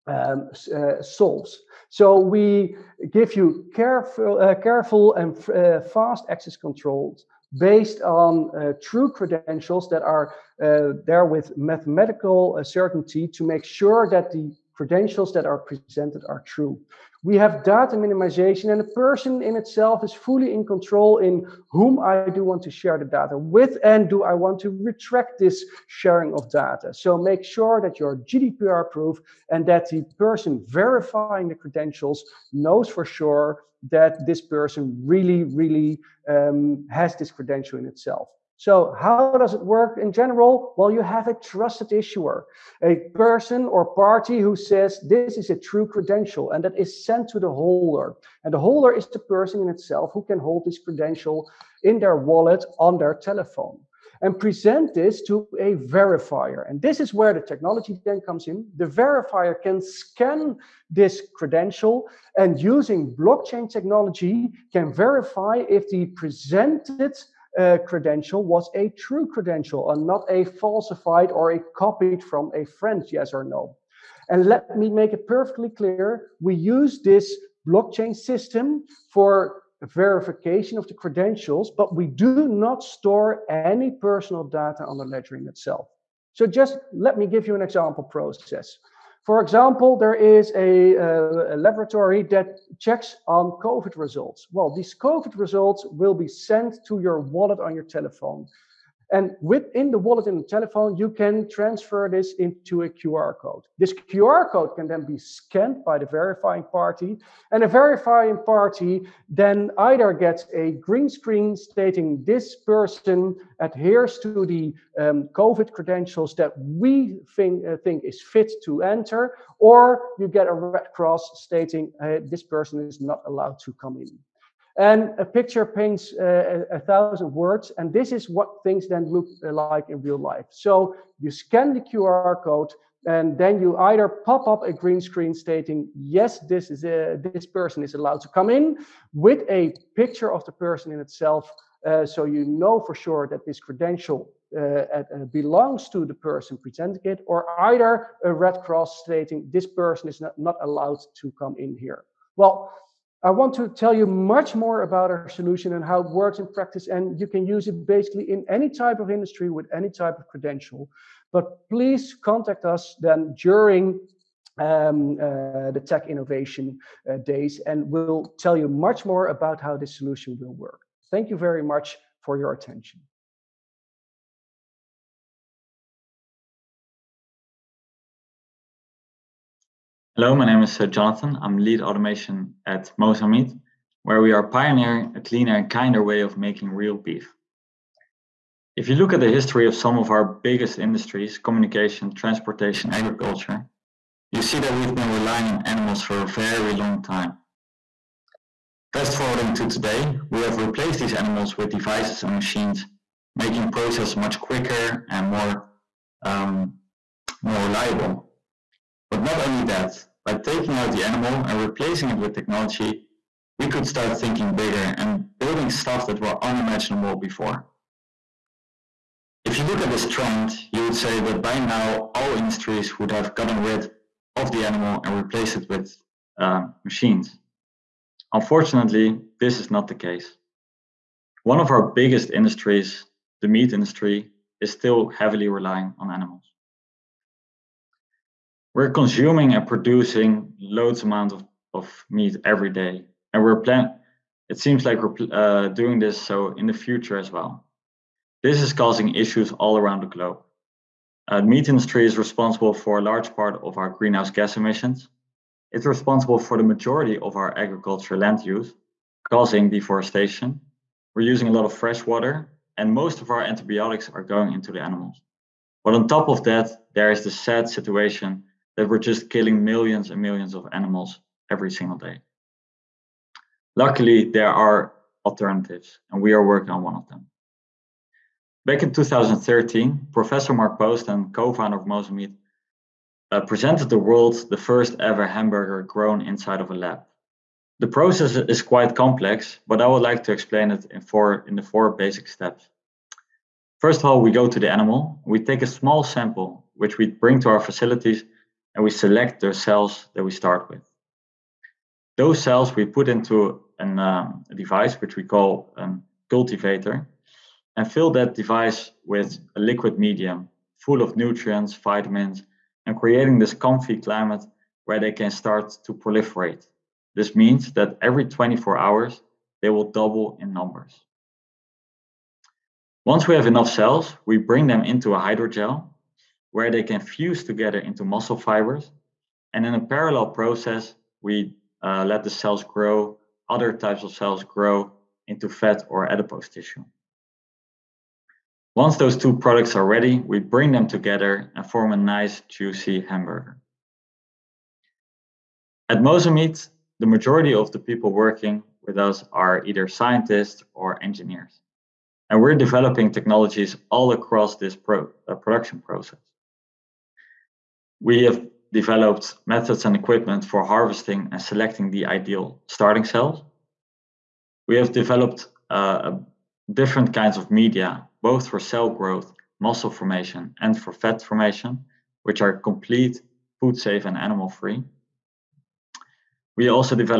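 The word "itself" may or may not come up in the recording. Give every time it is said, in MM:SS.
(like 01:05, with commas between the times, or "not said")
00:19, 00:37, 00:49, 01:25, 02:20.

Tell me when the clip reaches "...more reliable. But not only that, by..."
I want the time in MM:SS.
03:27.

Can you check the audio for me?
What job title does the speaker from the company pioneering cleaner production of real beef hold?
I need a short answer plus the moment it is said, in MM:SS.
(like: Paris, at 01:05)
lead automation, at 03:01.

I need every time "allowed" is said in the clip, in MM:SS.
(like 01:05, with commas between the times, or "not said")
02:03, 02:17, 02:30.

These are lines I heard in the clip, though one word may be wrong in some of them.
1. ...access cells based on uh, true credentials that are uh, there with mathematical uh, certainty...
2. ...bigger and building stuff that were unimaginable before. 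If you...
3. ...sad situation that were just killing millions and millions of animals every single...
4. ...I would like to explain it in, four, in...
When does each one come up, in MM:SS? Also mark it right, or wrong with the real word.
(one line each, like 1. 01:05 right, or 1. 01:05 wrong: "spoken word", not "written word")
1. 00:06 wrong: "controls", not "cells"
2. 03:34 right
3. 04:27 right
4. 04:49 right.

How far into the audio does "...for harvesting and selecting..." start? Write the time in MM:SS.
06:00.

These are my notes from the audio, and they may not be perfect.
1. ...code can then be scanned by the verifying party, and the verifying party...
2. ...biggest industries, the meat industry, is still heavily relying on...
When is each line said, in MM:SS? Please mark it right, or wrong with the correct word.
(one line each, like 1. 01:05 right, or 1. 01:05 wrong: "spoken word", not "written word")
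1. 01:44 right
2. 03:51 right.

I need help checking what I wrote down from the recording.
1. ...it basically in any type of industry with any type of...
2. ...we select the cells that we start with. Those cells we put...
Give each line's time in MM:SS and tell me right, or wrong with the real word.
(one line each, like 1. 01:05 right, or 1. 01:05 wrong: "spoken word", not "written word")
1. 02:37 right
2. 04:58 right.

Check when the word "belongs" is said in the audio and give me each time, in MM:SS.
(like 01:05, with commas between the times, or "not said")
02:25.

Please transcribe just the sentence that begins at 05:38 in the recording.
Once those two products are ready, we bring them together and form a nice juicy hamburger.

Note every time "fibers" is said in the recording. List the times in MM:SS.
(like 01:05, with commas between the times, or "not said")
05:28.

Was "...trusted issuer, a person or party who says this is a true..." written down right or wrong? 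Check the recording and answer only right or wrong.
right.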